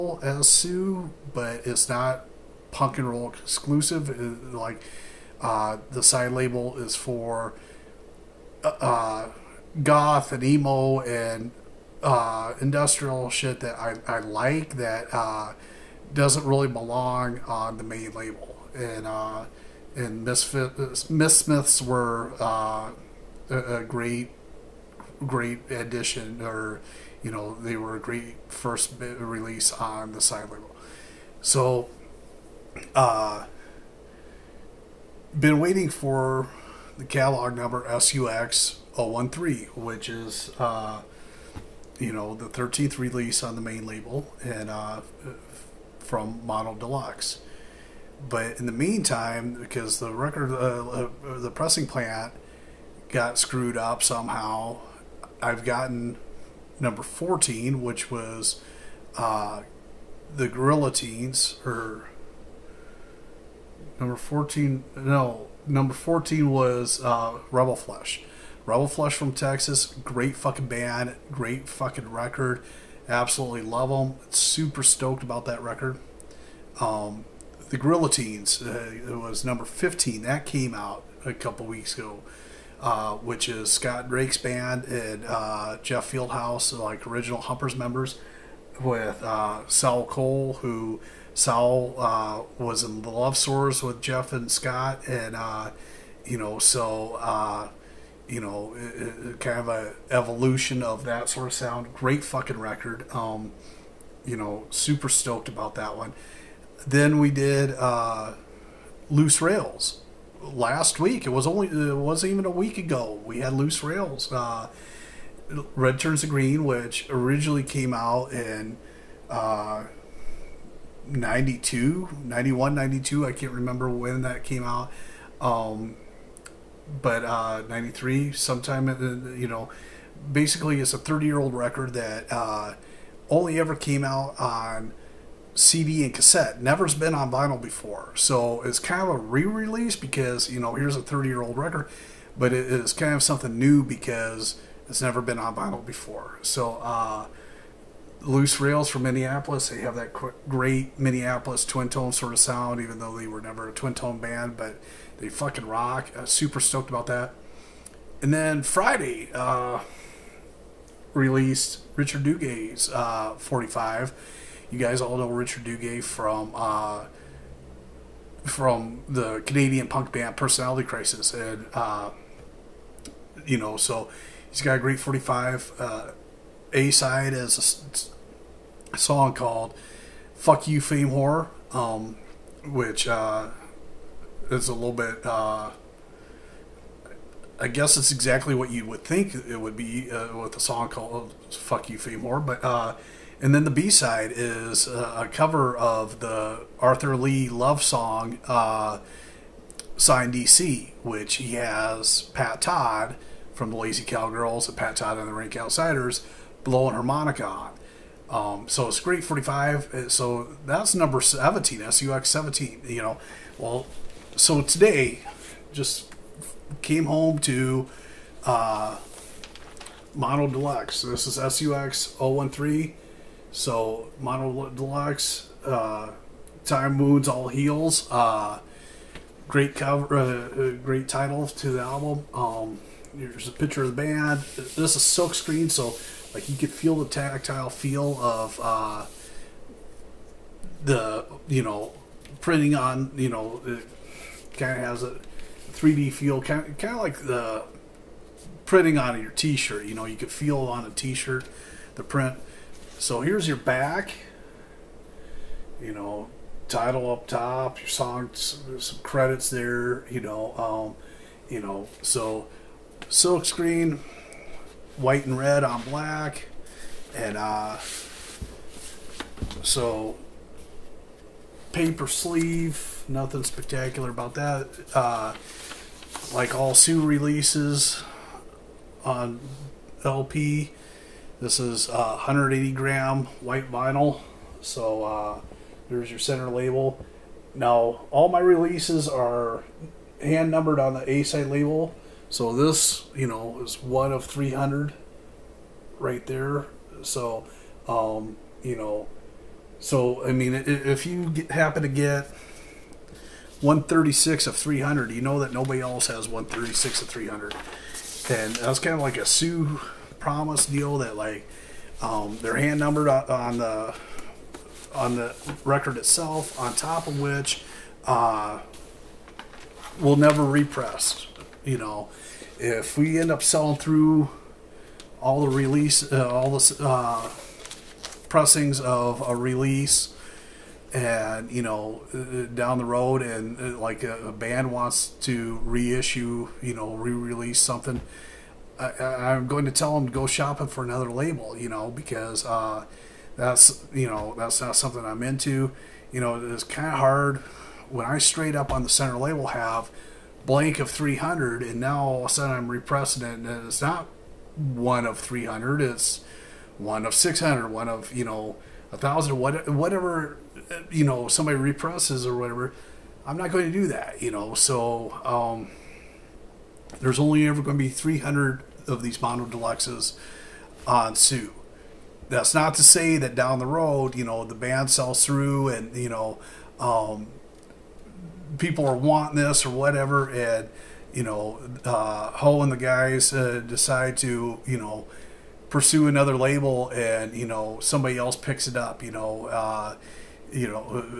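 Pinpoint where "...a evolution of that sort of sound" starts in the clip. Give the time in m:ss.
1:39.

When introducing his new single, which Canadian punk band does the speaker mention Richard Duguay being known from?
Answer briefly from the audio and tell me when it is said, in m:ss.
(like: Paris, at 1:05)
Personality Crisis, at 2:50.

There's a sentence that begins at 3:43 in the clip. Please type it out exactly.
So MonoDelux, uh, Time Wounds, all heels.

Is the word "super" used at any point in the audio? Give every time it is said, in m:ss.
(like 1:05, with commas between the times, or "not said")
1:14, 1:44, 2:36.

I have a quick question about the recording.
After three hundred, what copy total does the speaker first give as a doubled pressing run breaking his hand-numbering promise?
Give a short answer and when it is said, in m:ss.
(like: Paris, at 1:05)
600, at 5:56.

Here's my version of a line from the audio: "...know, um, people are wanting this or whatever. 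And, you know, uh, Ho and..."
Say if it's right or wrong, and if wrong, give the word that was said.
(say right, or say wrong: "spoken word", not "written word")
right.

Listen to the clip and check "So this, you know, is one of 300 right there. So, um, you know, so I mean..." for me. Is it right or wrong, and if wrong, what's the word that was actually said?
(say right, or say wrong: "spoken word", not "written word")
right.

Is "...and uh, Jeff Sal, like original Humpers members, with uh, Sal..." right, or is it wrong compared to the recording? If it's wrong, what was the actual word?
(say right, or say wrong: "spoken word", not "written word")
wrong: "Fieldhouse", not "Sal".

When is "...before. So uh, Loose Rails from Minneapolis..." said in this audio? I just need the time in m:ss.
2:25.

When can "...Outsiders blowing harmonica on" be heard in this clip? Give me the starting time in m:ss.
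3:25.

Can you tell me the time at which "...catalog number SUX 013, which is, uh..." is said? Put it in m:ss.
0:37.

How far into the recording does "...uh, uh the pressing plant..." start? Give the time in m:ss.
0:50.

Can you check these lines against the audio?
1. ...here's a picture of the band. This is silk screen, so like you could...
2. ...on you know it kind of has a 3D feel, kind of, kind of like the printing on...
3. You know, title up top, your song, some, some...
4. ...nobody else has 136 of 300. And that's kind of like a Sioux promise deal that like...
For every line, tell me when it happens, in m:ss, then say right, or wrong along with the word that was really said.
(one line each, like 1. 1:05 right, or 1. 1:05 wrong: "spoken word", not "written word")
1. 3:53 right
2. 4:02 right
3. 4:15 right
4. 5:05 right.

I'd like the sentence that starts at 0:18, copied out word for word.
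And and Mythsmiths were a, a great great addition or you know, they were a great first release on the side label.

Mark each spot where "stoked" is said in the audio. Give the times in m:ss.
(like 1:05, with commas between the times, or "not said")
1:14, 1:45, 2:36.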